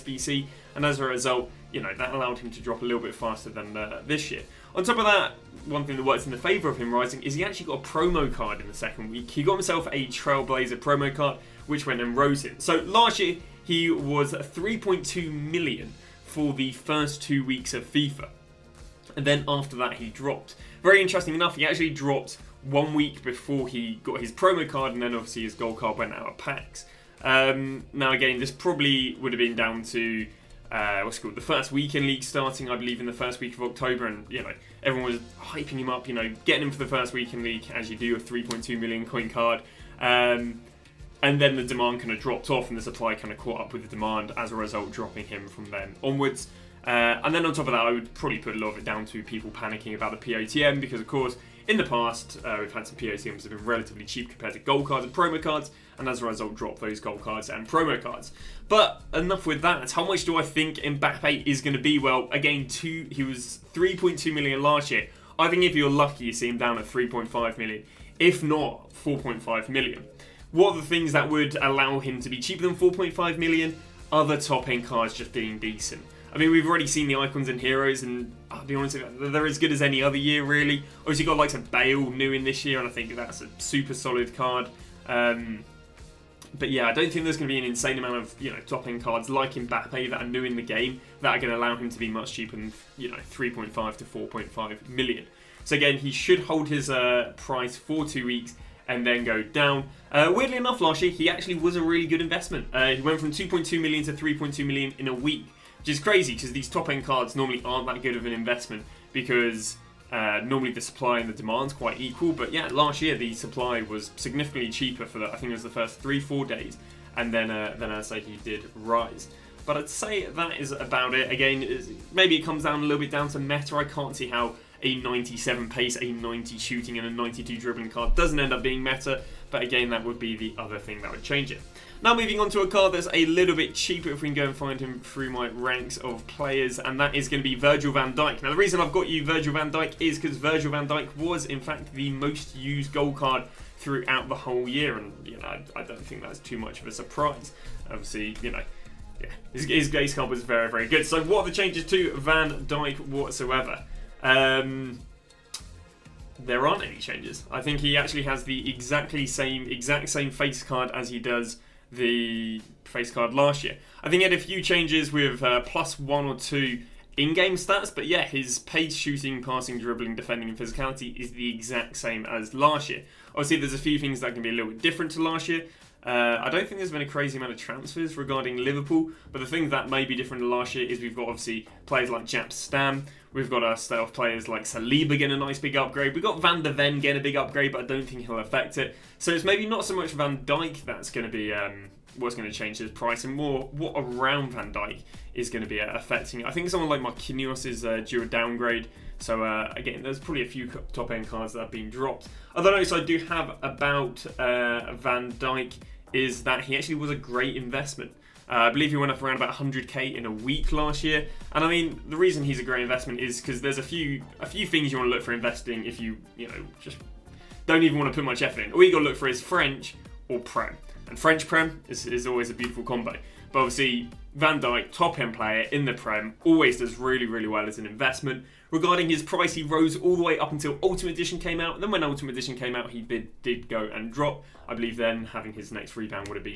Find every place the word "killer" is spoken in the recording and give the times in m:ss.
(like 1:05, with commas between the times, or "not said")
not said.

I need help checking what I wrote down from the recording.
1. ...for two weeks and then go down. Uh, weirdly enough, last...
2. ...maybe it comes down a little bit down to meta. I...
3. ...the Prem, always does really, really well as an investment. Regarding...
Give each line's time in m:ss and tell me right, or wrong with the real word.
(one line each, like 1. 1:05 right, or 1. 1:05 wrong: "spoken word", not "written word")
1. 1:37 right
2. 2:02 right
3. 3:45 right.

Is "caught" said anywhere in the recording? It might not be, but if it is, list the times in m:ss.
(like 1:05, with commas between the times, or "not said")
0:43.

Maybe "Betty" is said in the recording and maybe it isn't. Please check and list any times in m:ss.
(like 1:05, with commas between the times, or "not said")
not said.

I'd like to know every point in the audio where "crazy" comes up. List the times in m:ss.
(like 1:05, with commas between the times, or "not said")
1:45, 2:57.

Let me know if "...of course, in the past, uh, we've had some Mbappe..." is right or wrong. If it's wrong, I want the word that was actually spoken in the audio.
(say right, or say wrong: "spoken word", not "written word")
wrong: "POTMs", not "Mbappe".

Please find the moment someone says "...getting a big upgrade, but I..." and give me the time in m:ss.
3:06.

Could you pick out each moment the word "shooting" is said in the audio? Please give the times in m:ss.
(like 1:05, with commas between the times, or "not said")
2:06, 2:48.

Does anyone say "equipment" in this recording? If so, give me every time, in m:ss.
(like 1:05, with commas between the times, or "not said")
not said.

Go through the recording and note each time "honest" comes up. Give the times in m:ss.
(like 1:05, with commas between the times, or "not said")
1:18.